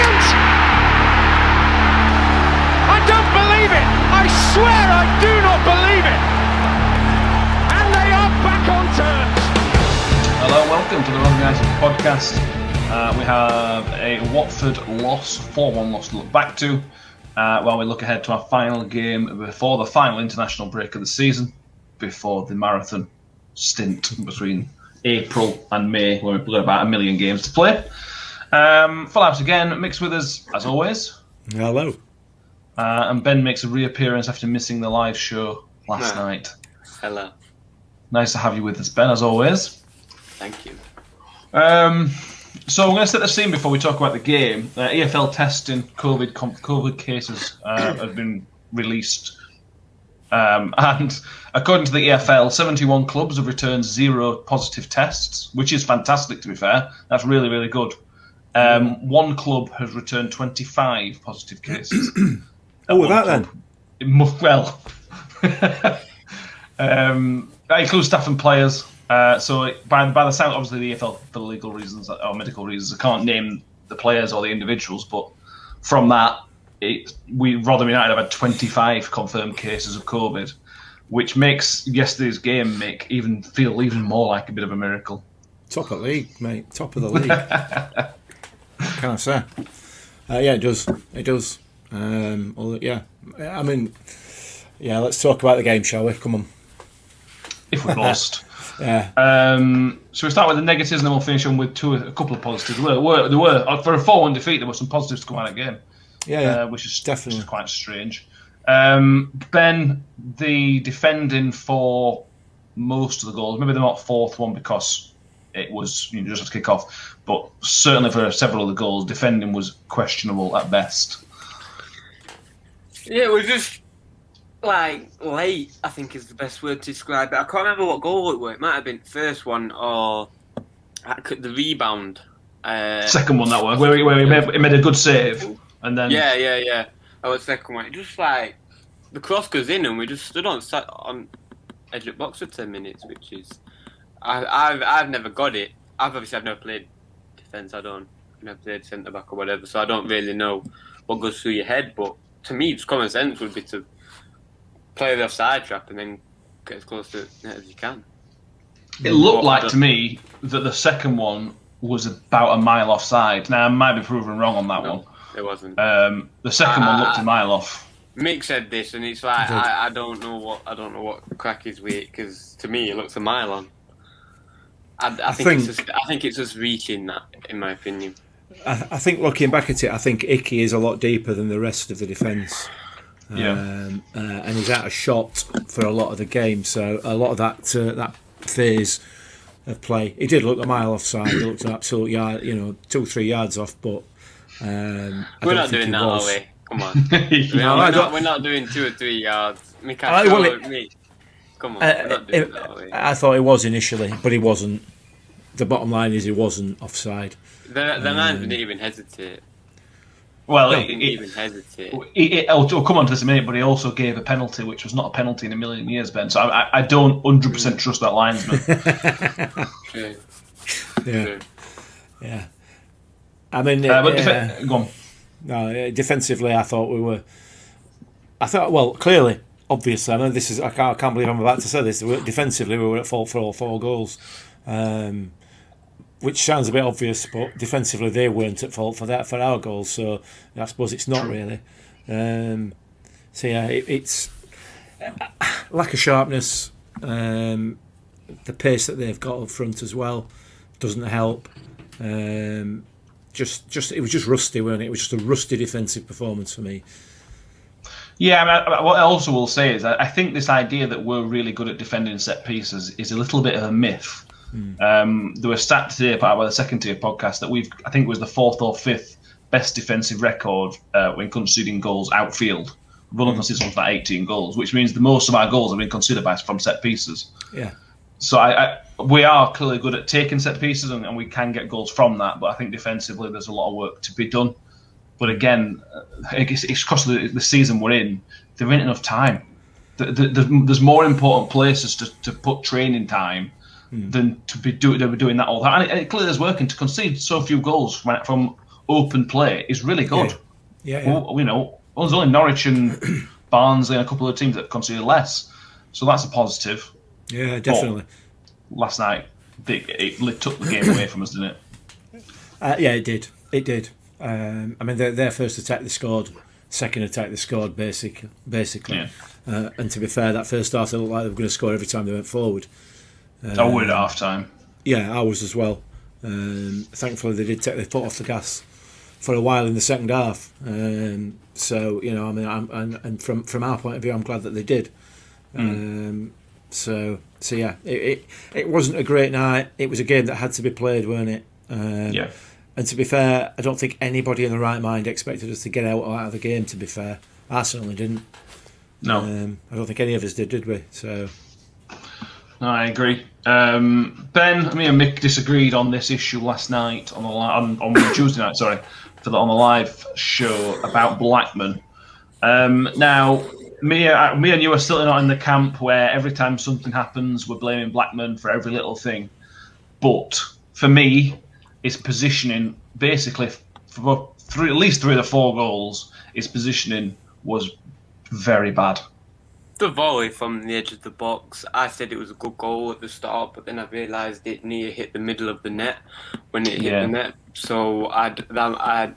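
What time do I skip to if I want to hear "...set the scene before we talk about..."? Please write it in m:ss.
0:43.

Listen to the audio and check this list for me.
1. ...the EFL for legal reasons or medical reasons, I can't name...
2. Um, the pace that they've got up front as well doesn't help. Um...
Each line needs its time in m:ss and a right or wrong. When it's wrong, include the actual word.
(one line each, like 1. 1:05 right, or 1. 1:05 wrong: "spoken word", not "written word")
1. 1:10 right
2. 4:07 right.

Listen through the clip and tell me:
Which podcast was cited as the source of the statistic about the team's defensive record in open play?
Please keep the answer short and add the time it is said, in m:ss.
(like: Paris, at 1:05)
the second tier podcast, at 4:26.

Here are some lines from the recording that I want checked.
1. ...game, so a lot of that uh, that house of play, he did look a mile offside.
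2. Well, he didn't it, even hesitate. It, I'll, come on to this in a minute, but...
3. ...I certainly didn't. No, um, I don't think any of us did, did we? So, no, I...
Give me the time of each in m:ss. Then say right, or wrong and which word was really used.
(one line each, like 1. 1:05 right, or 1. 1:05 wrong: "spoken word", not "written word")
1. 3:06 wrong: "phase", not "house"
2. 3:30 right
3. 5:47 right.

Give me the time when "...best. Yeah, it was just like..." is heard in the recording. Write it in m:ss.
2:00.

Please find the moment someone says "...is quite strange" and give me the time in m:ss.
1:47.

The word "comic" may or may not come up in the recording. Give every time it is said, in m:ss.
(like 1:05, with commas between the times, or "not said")
not said.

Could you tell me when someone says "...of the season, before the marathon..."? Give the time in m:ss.
0:20.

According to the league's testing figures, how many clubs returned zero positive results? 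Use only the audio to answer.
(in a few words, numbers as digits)
71.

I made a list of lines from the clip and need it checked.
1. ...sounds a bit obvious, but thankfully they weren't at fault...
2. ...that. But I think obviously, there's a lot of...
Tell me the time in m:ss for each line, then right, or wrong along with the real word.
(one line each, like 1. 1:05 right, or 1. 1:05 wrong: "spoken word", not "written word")
1. 3:56 wrong: "defensively", not "thankfully"
2. 4:42 wrong: "defensively", not "obviously".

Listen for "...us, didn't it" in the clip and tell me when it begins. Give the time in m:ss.
5:11.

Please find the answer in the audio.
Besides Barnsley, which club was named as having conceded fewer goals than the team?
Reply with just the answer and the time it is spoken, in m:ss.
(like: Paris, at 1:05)
Norwich, at 5:02.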